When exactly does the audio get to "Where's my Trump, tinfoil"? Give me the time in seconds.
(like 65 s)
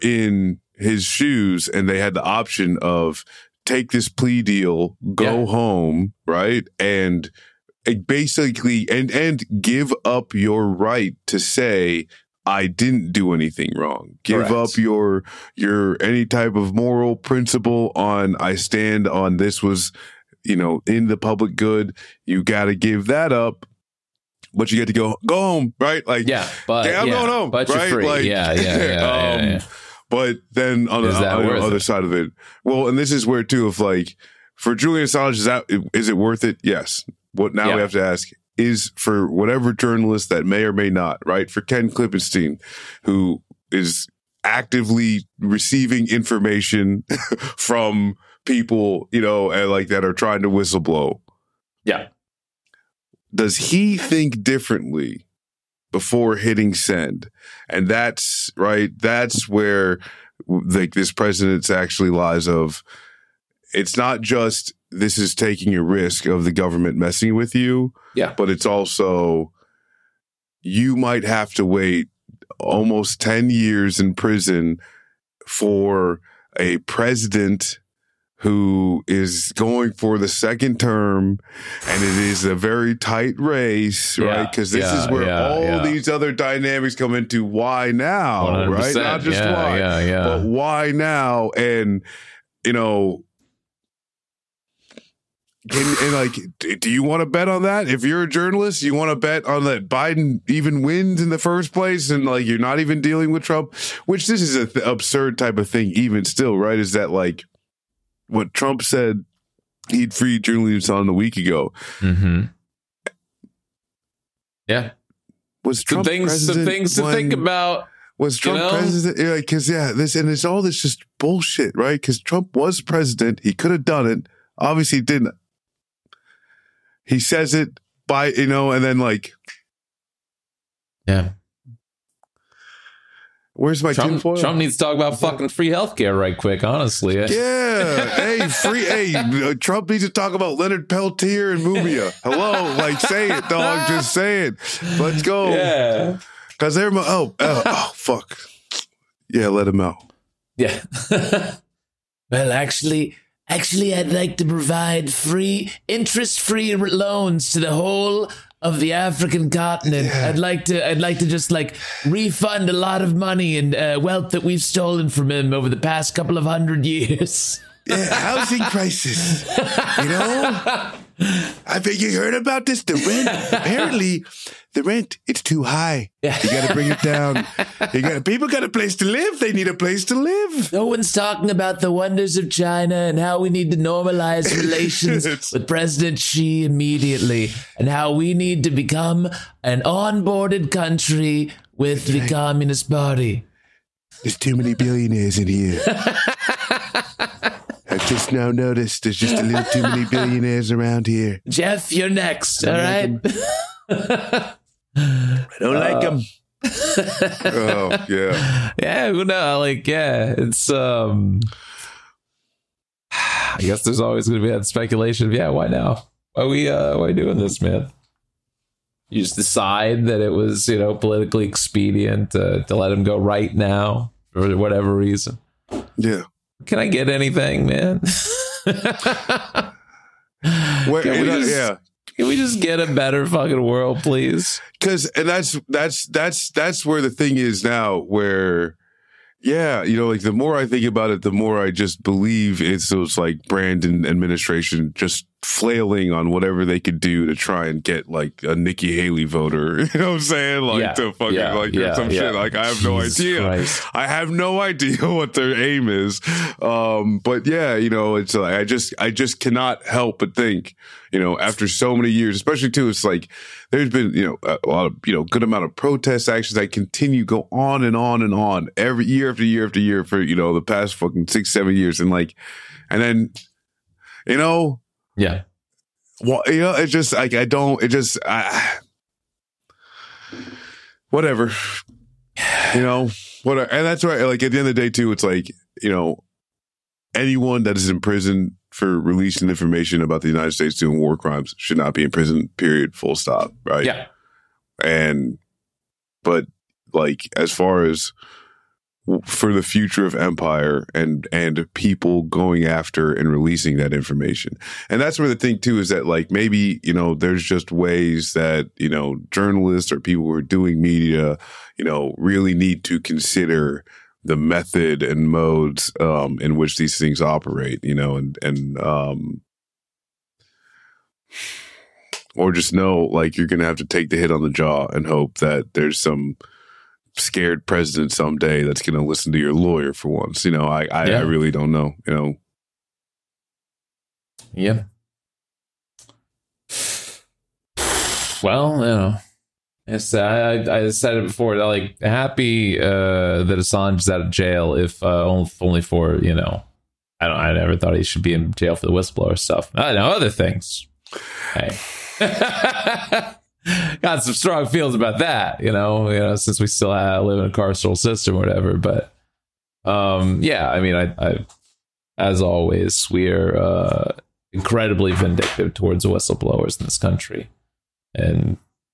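133 s.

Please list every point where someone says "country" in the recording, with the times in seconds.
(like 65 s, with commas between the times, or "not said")
190 s, 366 s.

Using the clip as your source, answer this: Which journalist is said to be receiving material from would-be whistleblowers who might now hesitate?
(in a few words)
Ken Klippenstein.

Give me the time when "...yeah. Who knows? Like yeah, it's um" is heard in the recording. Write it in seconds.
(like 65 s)
208 s.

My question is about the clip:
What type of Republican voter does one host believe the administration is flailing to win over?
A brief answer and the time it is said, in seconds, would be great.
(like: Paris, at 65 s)
Nikki Haley voter, at 248 s.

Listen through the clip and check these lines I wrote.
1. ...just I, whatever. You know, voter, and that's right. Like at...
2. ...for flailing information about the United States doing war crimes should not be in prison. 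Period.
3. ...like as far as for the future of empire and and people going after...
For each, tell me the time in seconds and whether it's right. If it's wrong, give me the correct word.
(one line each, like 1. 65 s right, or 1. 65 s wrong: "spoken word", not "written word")
1. 277 s wrong: "whatever", not "voter"
2. 288 s wrong: "releasing", not "flailing"
3. 296 s right.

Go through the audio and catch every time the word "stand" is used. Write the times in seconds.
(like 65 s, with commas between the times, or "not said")
18 s.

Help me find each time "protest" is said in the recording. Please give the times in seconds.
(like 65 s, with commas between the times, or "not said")
265 s.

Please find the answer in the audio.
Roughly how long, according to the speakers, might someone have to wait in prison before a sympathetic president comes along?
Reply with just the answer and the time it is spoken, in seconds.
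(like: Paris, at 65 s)
almost 10 years, at 72 s.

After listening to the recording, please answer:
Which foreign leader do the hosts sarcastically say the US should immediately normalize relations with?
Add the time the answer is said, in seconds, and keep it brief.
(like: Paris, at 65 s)
President Xi, at 185 s.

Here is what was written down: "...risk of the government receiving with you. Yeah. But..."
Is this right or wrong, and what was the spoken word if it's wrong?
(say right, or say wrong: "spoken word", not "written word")
wrong: "messing", not "receiving".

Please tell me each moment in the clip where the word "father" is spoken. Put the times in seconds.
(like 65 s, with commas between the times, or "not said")
not said.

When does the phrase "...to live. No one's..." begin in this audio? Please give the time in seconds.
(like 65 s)
180 s.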